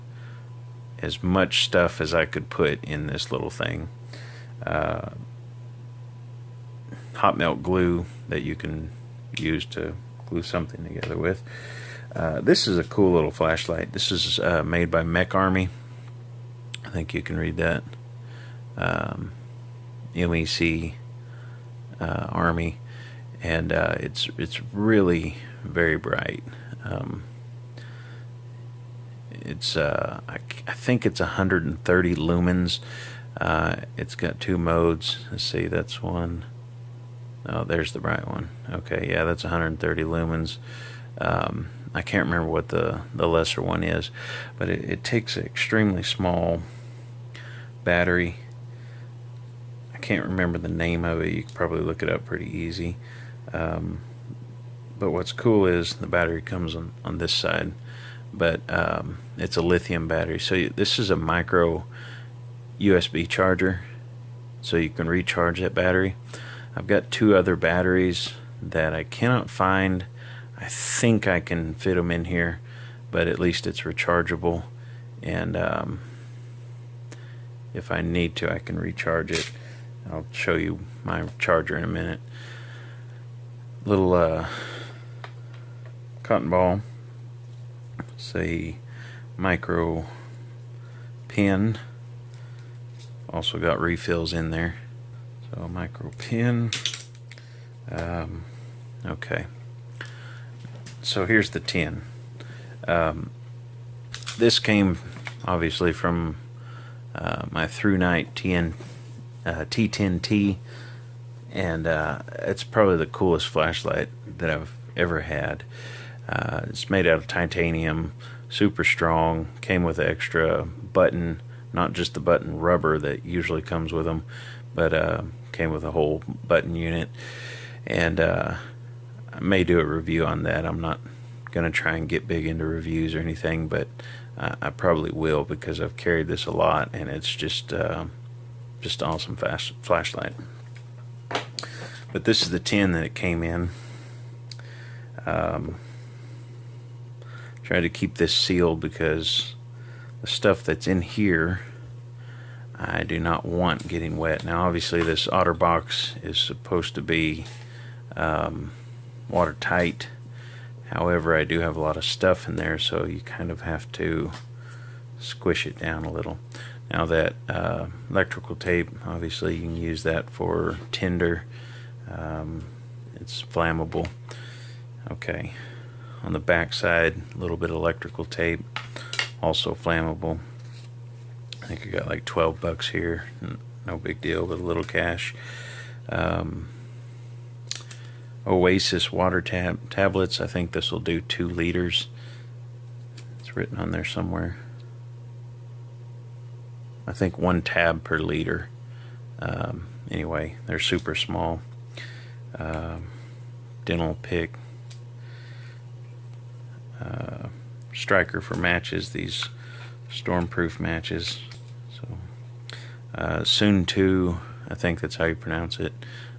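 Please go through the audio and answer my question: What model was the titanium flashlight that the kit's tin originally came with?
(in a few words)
ThruNite T10T.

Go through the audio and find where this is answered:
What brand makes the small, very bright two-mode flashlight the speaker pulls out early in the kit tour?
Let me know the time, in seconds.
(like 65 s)
15 s.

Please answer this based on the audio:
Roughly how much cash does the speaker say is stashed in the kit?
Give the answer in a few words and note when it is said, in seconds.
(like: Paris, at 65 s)
$12, at 182 s.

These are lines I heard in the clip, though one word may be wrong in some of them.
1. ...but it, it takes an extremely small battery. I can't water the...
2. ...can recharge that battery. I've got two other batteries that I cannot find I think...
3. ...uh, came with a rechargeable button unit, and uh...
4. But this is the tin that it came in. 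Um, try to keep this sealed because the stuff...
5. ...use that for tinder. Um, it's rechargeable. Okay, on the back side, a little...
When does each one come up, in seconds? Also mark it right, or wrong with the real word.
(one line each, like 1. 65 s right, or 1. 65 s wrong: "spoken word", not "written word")
1. 44 s wrong: "remember", not "water"
2. 64 s right
3. 124 s wrong: "whole", not "rechargeable"
4. 142 s right
5. 169 s wrong: "flammable", not "rechargeable".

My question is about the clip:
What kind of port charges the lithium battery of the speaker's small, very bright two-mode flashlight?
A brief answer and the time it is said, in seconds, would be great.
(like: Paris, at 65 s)
Micro USB, at 61 s.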